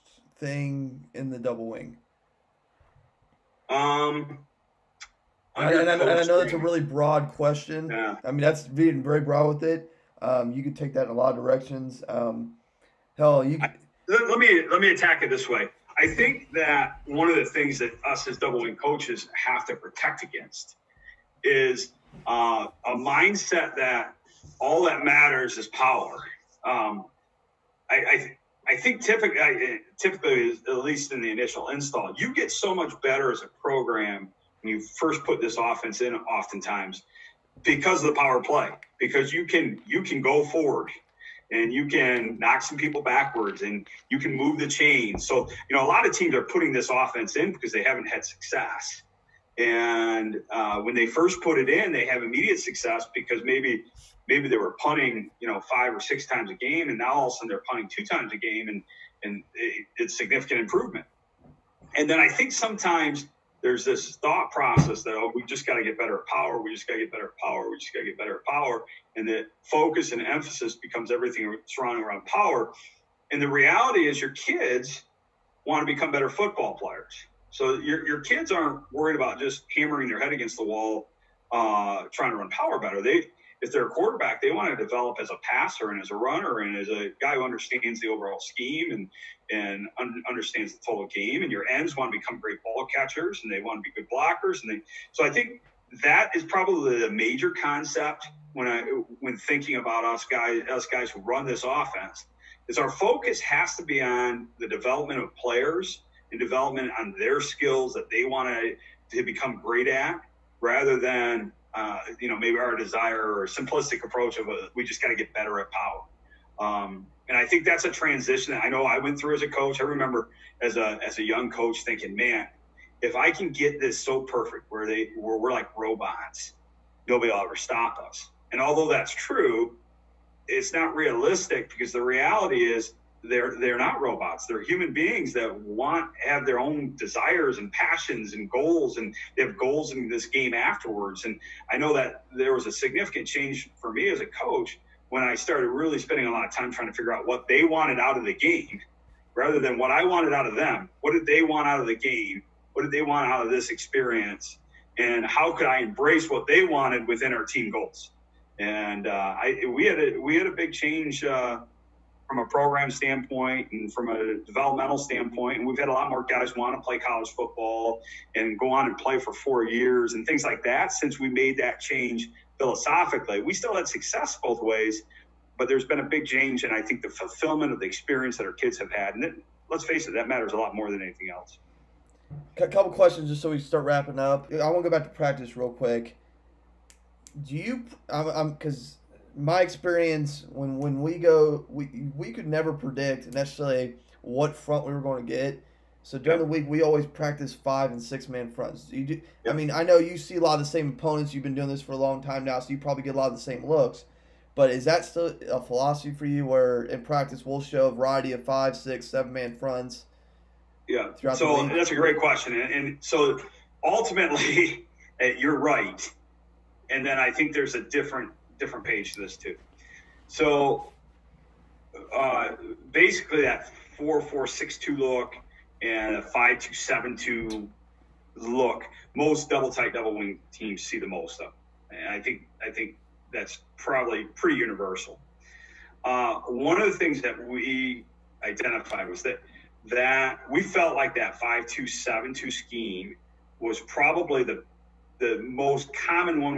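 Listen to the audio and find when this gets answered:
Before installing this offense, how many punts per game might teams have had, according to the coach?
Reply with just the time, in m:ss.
0:55.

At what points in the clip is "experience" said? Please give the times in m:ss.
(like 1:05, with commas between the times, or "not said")
2:33, 2:57, 3:09.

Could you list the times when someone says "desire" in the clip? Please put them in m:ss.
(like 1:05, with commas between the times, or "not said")
1:52, 2:16.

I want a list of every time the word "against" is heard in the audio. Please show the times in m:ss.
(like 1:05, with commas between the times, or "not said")
0:20, 1:20.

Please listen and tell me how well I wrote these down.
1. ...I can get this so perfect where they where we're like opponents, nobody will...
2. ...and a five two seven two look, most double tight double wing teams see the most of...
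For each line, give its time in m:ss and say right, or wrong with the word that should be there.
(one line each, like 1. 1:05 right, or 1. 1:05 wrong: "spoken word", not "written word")
1. 2:03 wrong: "robots", not "opponents"
2. 3:45 right.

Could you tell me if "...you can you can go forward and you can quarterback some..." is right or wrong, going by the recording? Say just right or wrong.
wrong.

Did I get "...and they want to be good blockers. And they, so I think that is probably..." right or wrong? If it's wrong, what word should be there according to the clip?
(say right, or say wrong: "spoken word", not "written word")
right.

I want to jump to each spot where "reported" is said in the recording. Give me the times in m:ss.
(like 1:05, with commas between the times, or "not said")
not said.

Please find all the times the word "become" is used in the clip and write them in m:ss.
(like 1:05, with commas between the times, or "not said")
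1:10, 1:15, 1:32, 1:49.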